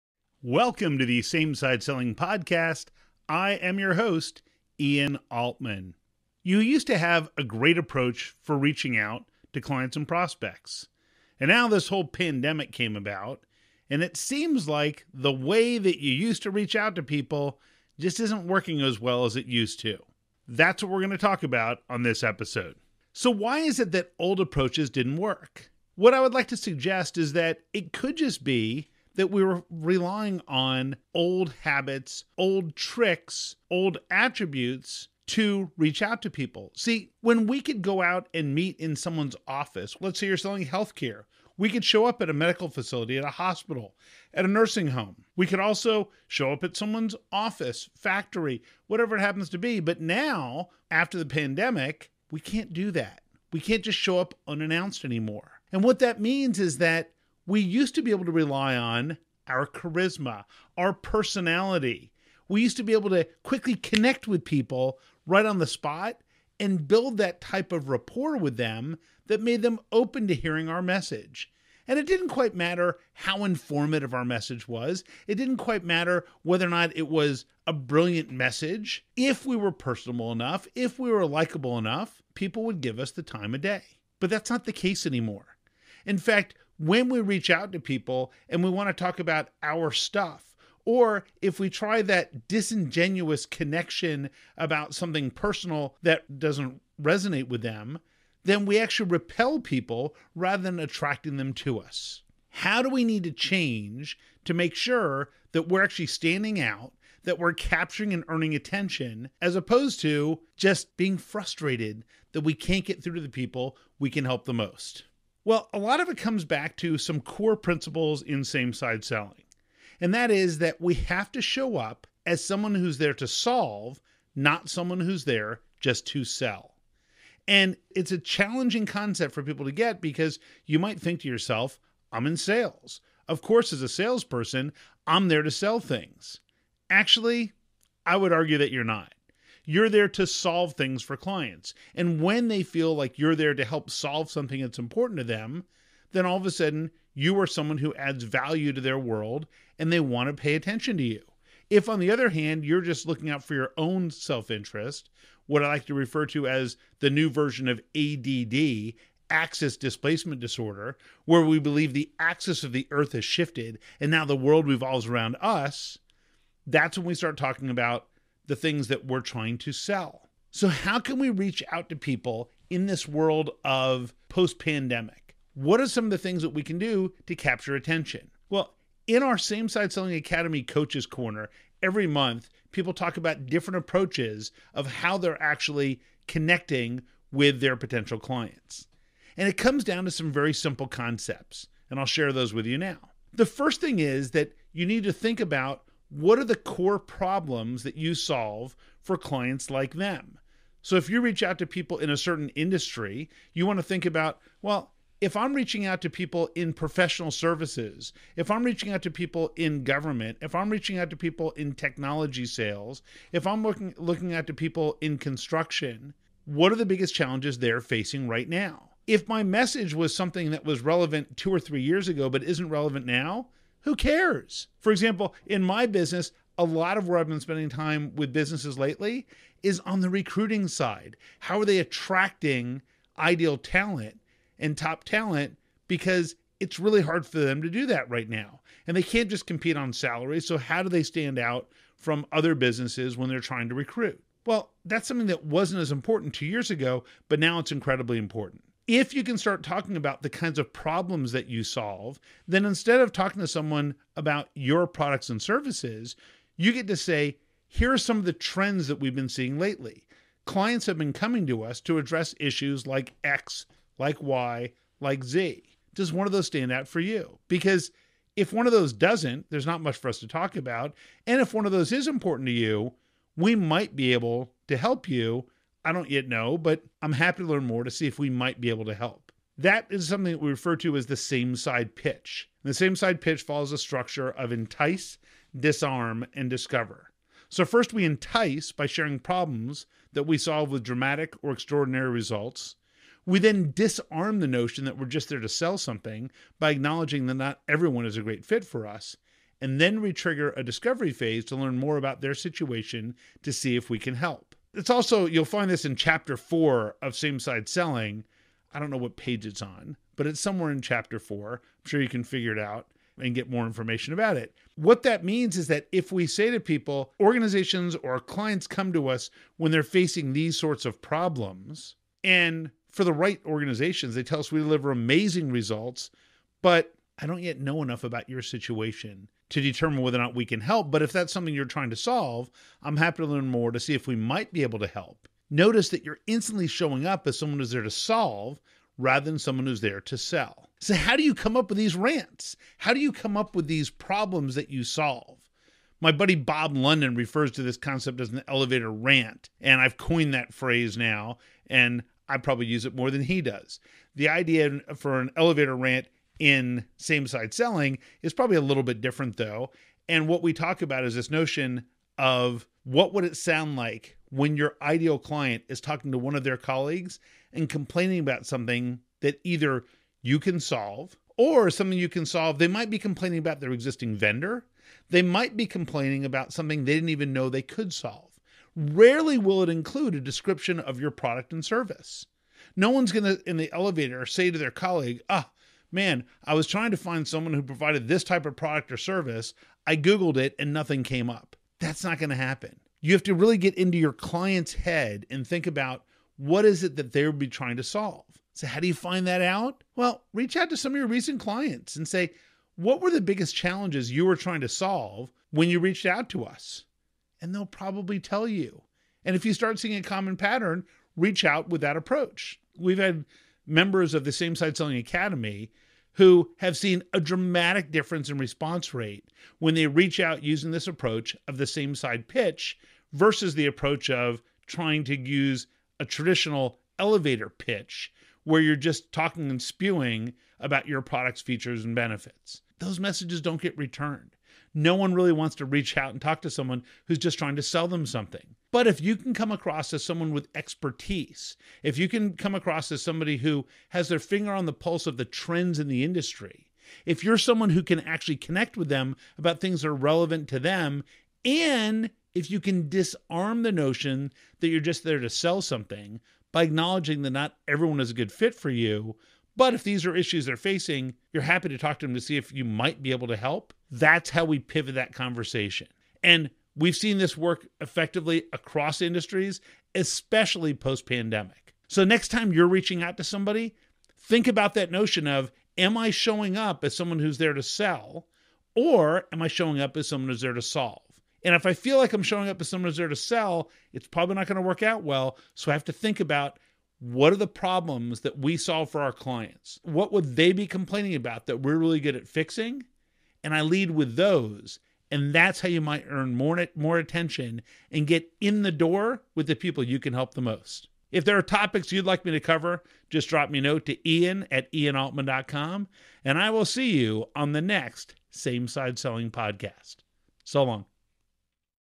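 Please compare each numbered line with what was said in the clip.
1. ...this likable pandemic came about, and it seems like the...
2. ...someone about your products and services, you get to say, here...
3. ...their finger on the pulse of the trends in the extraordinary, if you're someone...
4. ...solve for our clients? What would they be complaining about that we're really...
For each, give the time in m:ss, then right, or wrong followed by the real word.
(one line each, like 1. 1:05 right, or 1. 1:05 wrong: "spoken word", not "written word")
1. 0:11 wrong: "whole", not "likable"
2. 4:13 right
3. 7:24 wrong: "industry", not "extraordinary"
4. 8:08 right.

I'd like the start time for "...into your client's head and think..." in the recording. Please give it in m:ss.
6:33.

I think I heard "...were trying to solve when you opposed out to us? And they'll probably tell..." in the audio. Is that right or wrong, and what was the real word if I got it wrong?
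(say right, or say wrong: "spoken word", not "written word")
wrong: "reached", not "opposed".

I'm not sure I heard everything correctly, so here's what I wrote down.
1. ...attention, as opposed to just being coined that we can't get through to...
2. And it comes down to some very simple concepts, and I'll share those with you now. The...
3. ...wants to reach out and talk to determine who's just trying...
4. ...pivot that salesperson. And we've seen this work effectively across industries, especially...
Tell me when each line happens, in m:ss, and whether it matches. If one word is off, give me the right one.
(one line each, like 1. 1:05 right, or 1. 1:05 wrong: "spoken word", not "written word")
1. 1:48 wrong: "frustrated", not "coined"
2. 3:09 right
3. 7:15 wrong: "someone", not "determine"
4. 7:44 wrong: "conversation", not "salesperson".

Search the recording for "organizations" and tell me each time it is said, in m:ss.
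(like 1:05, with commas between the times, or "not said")
5:17, 5:23.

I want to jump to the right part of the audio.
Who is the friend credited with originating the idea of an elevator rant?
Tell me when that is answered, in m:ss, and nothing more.
5:46.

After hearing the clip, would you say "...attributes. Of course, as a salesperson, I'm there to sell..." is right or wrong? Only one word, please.
wrong.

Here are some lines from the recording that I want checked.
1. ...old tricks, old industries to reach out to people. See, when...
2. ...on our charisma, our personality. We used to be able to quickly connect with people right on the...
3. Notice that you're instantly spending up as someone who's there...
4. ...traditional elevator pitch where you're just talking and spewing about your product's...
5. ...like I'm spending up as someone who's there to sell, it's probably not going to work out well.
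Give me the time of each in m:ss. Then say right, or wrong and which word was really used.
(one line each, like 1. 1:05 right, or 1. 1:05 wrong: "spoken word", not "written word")
1. 0:32 wrong: "attributes", not "industries"
2. 0:58 right
3. 5:35 wrong: "showing", not "spending"
4. 7:06 right
5. 8:01 wrong: "showing", not "spending".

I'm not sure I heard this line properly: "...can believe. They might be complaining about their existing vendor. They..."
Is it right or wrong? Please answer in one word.
wrong.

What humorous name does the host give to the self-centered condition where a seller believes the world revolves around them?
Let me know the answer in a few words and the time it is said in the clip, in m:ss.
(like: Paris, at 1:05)
Axis displacement disorder, at 2:39.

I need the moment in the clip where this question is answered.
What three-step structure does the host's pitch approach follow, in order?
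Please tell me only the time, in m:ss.
4:44.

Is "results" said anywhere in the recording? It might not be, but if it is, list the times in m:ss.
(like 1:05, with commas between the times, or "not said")
4:52, 5:25.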